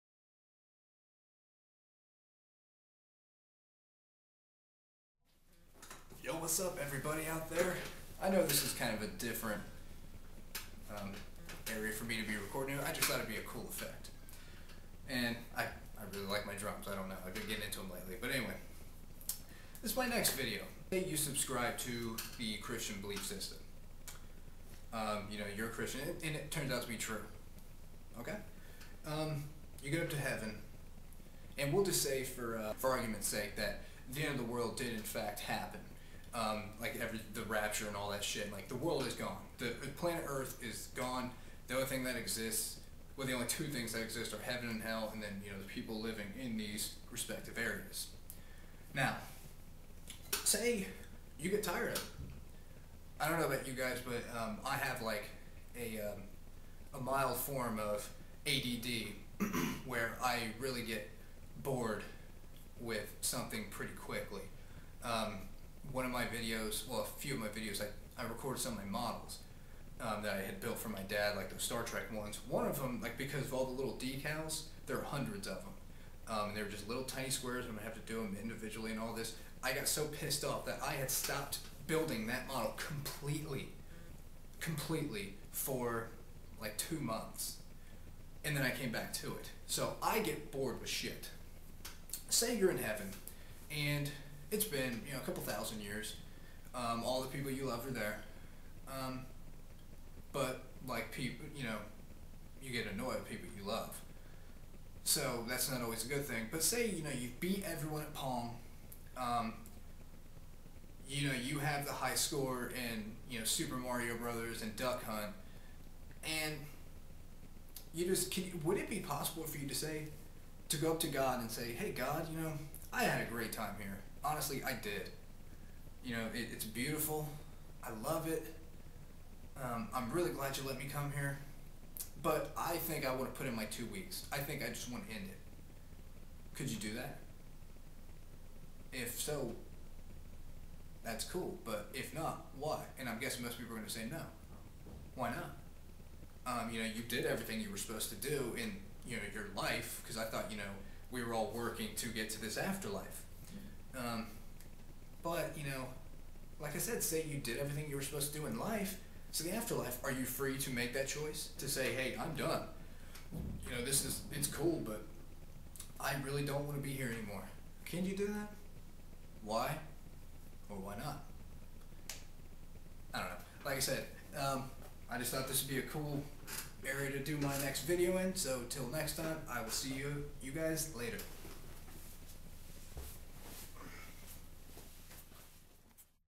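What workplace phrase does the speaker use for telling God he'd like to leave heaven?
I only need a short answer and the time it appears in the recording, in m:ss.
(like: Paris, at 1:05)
put in my two weeks, at 2:13.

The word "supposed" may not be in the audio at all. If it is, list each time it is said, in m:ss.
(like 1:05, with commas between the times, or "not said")
2:27, 2:38.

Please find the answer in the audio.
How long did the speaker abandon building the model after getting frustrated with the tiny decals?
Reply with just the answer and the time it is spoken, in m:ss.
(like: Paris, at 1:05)
2 months, at 1:26.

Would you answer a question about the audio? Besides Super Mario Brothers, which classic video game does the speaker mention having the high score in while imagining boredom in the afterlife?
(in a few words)
Duck Hunt.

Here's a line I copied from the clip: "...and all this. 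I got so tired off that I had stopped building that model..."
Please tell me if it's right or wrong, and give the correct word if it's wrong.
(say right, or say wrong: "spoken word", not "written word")
wrong: "pissed", not "tired".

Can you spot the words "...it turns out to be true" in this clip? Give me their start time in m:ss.
0:26.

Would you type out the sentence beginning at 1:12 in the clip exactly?
One of them, like because of all the little decals, there are hundreds of them.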